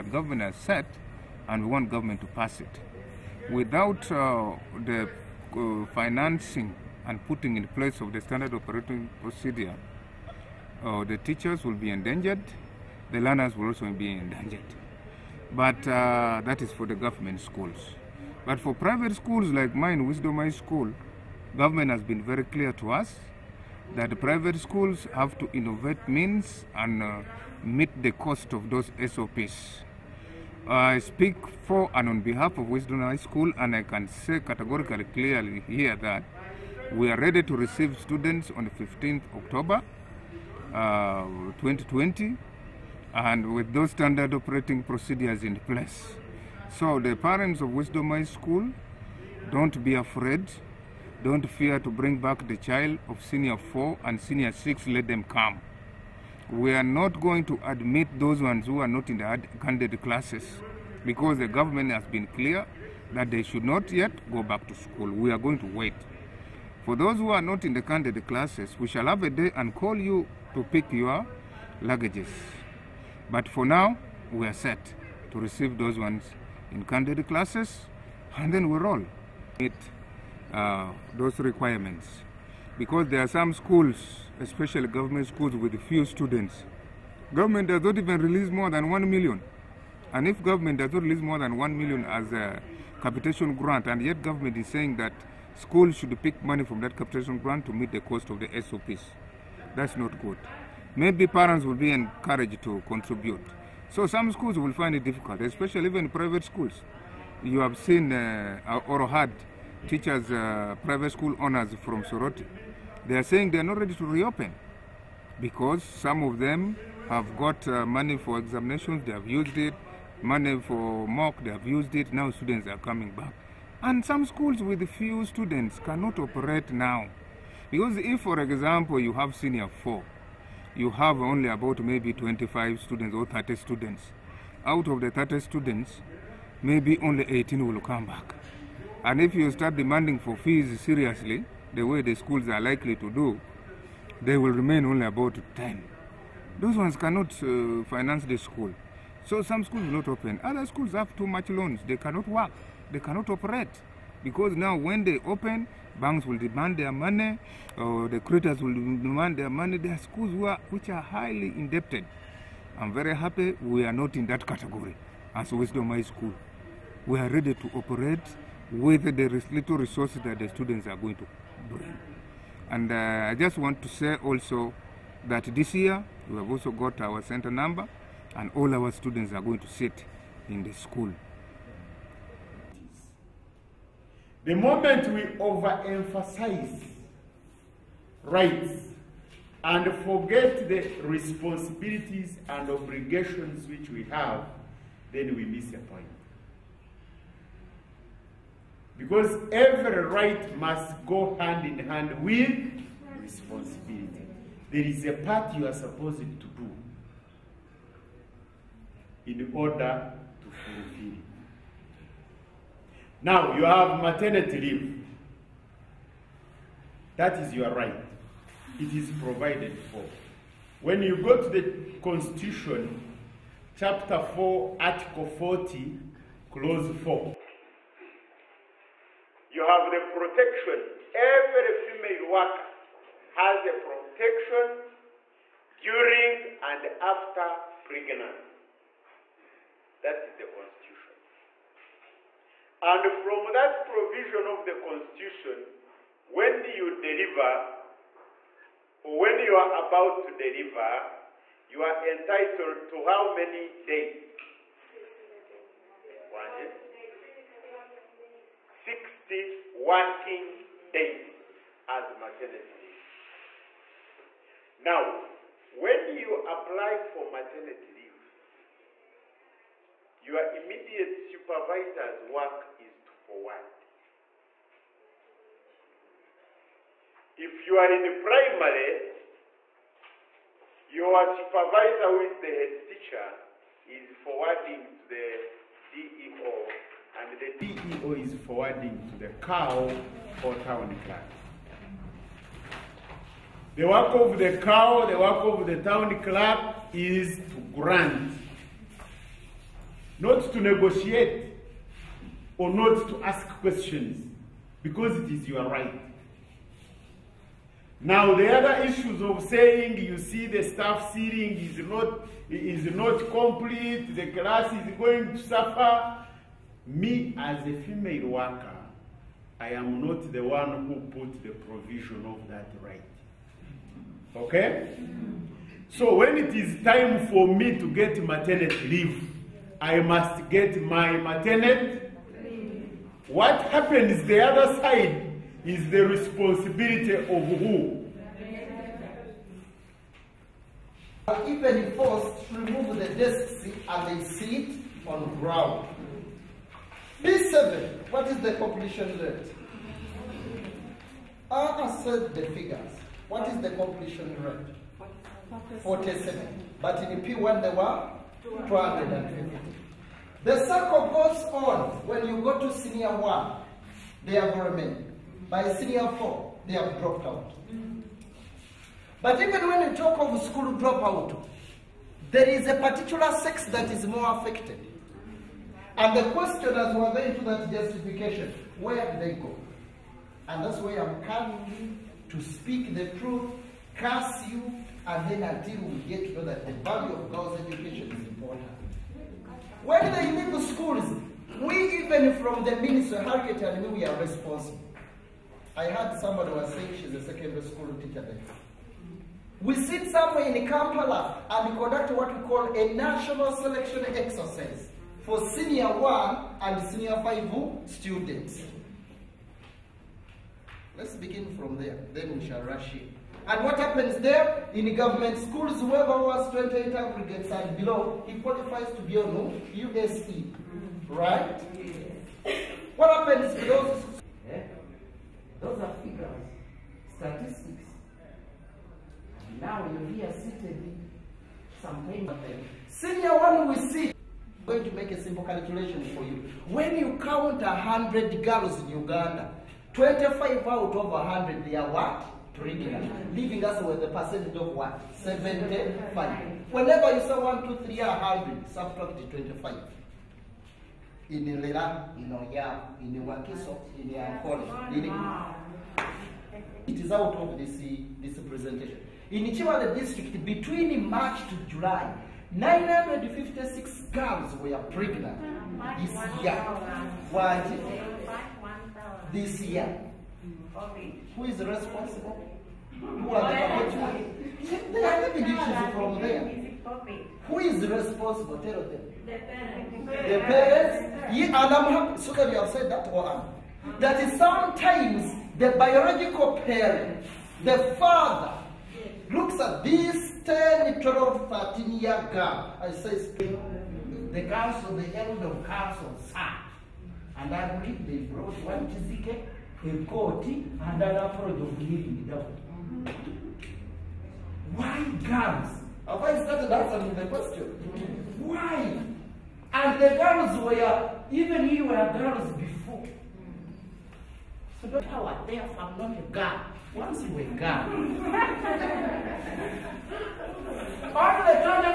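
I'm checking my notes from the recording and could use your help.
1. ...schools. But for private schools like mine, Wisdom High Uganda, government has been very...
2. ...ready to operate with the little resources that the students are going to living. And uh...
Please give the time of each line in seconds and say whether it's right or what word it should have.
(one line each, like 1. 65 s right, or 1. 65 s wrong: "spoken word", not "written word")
1. 17 s wrong: "School", not "Uganda"
2. 167 s wrong: "bring", not "living".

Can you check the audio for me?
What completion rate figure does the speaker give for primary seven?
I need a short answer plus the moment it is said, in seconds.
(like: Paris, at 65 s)
47, at 355 s.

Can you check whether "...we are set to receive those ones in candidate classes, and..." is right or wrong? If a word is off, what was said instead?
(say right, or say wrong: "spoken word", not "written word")
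right.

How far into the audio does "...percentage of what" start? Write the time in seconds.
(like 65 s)
444 s.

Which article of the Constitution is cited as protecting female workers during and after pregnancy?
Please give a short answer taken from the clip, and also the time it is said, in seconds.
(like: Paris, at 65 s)
Article 40, at 224 s.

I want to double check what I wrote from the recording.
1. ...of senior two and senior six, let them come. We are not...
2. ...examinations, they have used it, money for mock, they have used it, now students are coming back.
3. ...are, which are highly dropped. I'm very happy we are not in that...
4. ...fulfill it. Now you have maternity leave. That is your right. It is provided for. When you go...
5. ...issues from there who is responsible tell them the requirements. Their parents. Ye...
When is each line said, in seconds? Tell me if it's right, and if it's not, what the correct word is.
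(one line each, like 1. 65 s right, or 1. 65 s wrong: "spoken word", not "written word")
1. 53 s wrong: "four", not "two"
2. 118 s right
3. 160 s wrong: "indebted", not "dropped"
4. 210 s right
5. 475 s wrong: "parents", not "requirements".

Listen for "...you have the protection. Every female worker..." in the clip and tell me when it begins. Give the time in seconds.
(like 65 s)
229 s.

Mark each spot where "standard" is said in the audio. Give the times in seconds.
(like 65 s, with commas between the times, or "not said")
8 s, 43 s.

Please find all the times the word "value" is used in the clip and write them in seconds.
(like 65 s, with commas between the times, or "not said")
386 s.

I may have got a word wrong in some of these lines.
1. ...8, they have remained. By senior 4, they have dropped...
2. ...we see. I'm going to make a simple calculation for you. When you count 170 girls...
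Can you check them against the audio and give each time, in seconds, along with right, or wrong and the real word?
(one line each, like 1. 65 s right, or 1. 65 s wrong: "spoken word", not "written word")
1. 363 s wrong: "1", not "8"
2. 433 s wrong: "100", not "170".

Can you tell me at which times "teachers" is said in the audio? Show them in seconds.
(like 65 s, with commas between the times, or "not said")
11 s, 109 s, 282 s, 398 s.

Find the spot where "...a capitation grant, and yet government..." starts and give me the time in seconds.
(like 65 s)
92 s.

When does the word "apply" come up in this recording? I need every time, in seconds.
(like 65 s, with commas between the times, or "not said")
266 s.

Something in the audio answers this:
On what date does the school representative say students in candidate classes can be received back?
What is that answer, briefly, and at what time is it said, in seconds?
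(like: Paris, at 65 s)
15th October 2020, at 38 s.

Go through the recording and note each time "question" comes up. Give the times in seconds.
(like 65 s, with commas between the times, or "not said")
303 s, 376 s, 507 s.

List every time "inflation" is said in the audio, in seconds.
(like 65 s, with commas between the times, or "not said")
not said.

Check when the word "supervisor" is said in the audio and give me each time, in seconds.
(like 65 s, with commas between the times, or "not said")
271 s, 281 s.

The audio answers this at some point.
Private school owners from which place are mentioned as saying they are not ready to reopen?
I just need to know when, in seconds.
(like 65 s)
112 s.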